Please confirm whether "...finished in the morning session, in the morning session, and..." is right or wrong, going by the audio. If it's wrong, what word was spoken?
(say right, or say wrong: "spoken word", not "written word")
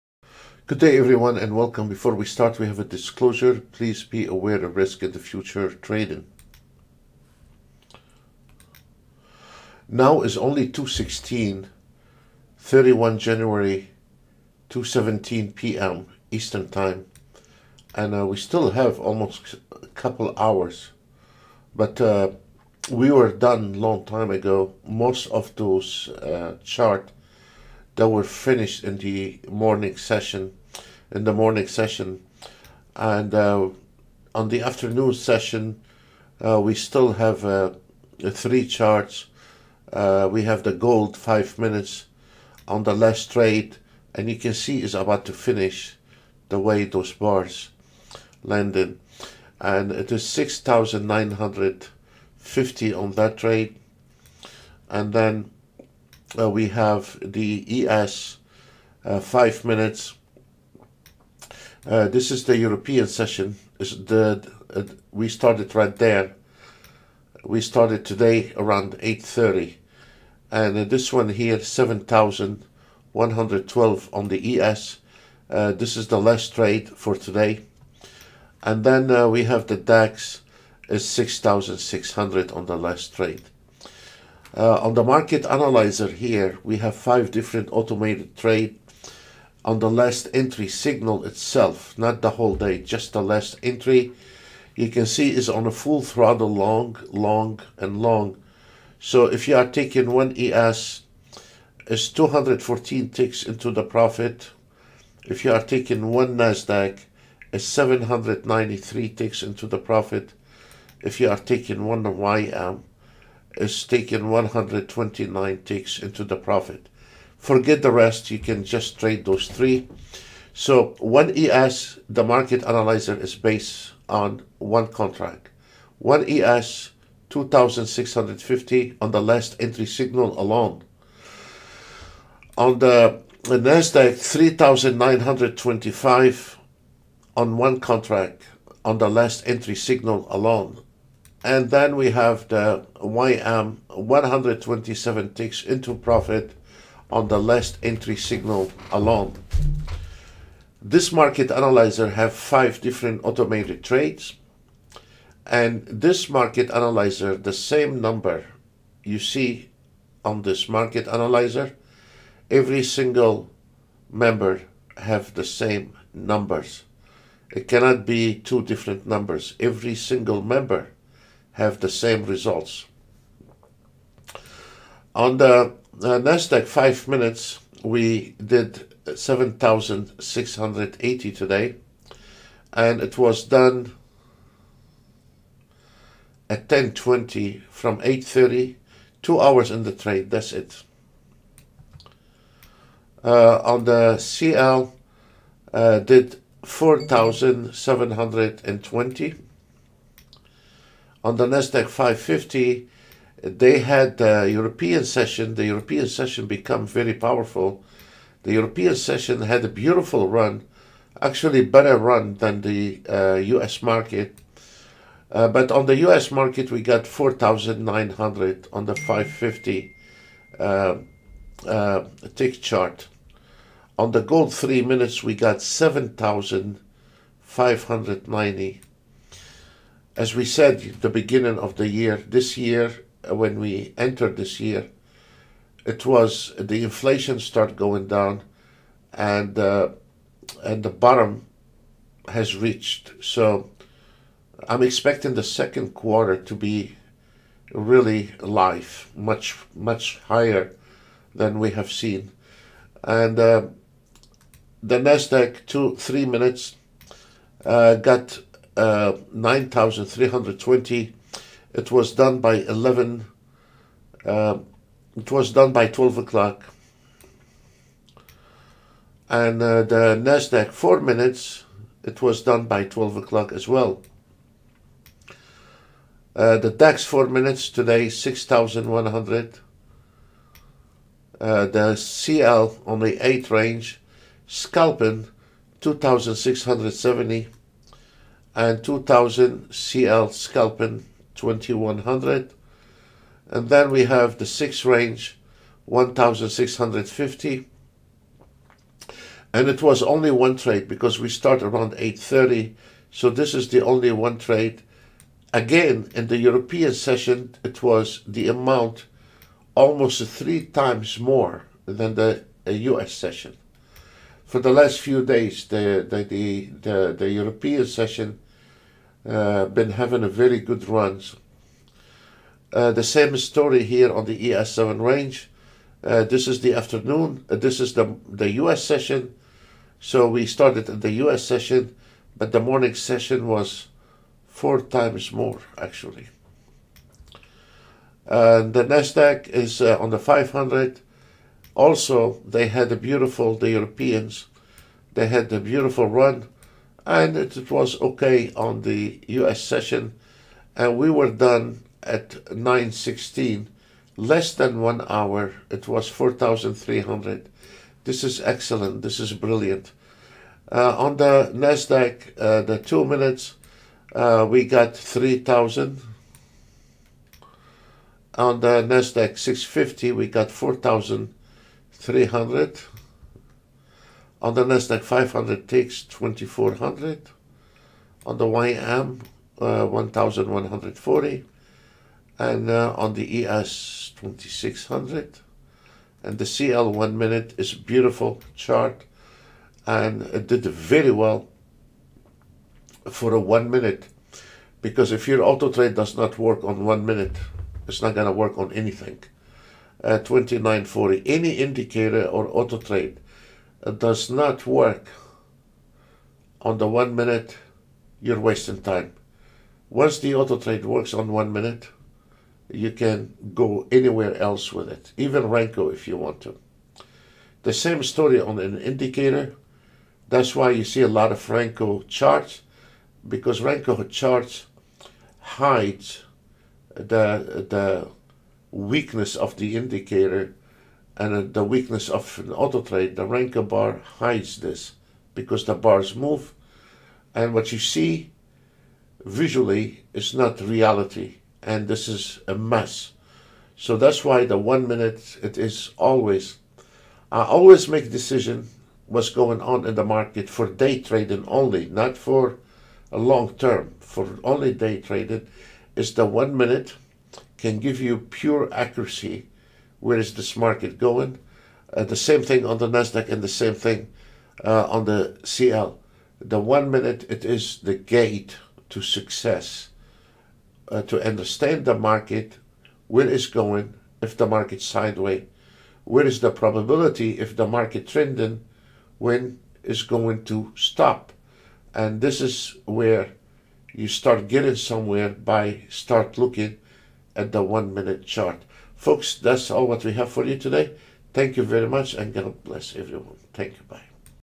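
right.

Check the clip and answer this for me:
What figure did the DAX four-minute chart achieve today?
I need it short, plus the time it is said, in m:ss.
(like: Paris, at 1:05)
6,100, at 4:38.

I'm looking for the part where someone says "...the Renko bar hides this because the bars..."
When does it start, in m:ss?
7:13.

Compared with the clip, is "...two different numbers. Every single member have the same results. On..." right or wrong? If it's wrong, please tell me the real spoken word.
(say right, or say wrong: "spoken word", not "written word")
right.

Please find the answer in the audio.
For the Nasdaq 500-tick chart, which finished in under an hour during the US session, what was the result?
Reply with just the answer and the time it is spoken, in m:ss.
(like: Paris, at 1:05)
4300, at 5:56.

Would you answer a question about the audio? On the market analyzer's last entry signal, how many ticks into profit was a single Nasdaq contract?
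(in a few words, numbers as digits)
793.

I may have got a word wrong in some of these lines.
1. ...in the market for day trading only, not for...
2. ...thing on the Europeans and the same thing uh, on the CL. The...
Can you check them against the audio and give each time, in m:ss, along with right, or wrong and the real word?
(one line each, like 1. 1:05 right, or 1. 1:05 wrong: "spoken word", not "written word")
1. 7:29 right
2. 7:42 wrong: "Nasdaq", not "Europeans".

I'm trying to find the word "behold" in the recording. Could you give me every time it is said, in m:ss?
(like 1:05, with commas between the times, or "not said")
not said.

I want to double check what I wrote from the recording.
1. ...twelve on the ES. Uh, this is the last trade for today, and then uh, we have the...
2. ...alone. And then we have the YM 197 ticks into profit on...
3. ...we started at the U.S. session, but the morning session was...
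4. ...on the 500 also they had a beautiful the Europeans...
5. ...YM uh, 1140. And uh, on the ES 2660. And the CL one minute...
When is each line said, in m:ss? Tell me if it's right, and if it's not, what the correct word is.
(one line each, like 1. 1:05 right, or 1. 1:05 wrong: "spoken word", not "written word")
1. 1:13 right
2. 2:20 wrong: "127", not "197"
3. 5:30 right
4. 5:40 right
5. 6:18 wrong: "2600", not "2660".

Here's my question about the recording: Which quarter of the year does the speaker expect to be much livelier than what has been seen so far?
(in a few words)
second quarter.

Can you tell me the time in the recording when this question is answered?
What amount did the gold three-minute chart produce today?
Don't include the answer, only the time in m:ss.
3:45.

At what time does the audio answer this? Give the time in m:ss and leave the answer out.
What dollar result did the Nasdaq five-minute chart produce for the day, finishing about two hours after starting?
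2:59.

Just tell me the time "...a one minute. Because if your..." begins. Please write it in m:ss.
6:33.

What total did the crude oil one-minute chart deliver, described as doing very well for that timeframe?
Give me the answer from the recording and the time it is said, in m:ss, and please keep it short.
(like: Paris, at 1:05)
2940, at 6:40.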